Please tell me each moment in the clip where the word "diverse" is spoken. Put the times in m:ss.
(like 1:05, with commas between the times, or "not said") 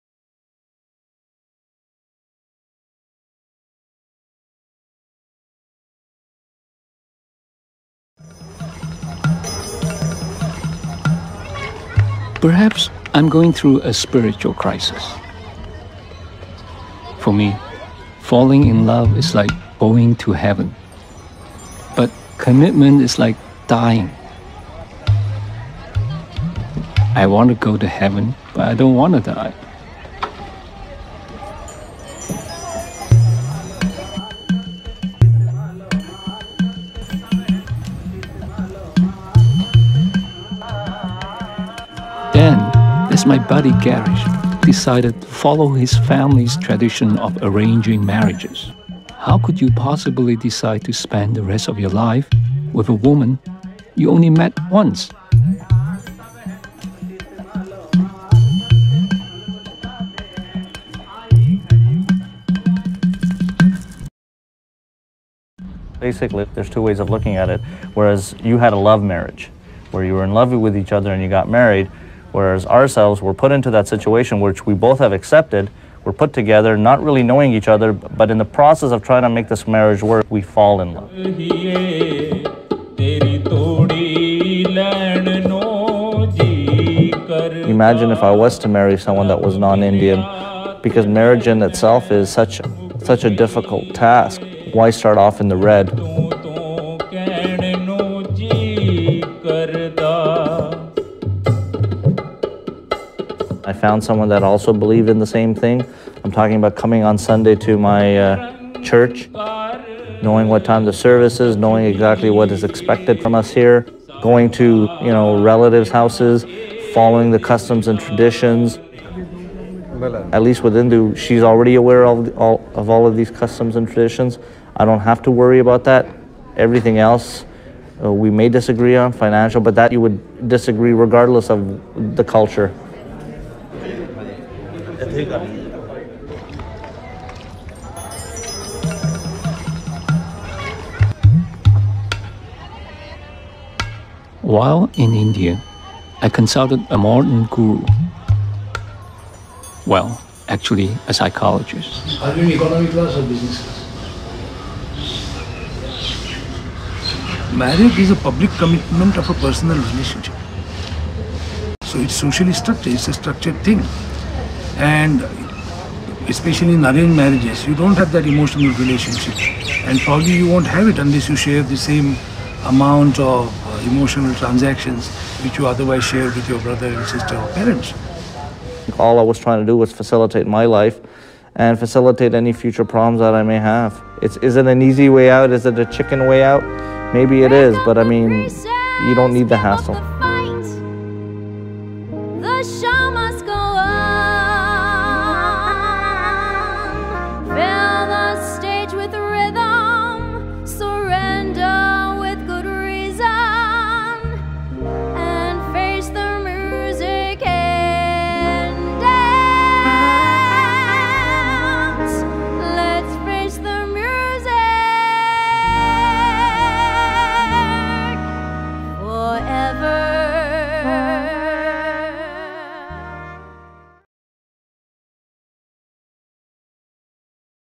not said.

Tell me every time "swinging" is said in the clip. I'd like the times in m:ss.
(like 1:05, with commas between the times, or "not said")
not said.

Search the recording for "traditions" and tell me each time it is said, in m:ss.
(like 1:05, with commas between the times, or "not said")
0:46, 1:57, 2:03.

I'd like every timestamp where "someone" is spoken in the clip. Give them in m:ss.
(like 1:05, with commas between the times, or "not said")
1:28, 1:44.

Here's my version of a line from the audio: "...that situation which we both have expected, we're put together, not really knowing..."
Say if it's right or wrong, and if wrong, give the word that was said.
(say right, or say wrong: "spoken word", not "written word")
wrong: "accepted", not "expected".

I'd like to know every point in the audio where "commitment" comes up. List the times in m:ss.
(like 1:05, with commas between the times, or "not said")
0:22, 2:38.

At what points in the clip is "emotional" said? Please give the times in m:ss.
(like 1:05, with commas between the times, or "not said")
2:48, 2:53.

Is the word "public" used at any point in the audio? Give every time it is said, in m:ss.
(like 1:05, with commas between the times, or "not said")
2:38.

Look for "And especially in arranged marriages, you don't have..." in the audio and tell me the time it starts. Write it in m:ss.
2:44.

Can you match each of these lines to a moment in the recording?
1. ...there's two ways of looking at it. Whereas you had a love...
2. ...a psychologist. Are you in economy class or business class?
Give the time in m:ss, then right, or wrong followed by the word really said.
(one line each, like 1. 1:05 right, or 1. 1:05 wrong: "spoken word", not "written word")
1. 1:06 right
2. 2:31 right.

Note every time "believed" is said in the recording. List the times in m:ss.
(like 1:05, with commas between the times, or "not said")
1:44.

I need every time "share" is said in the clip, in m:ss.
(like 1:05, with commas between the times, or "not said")
2:51, 2:56.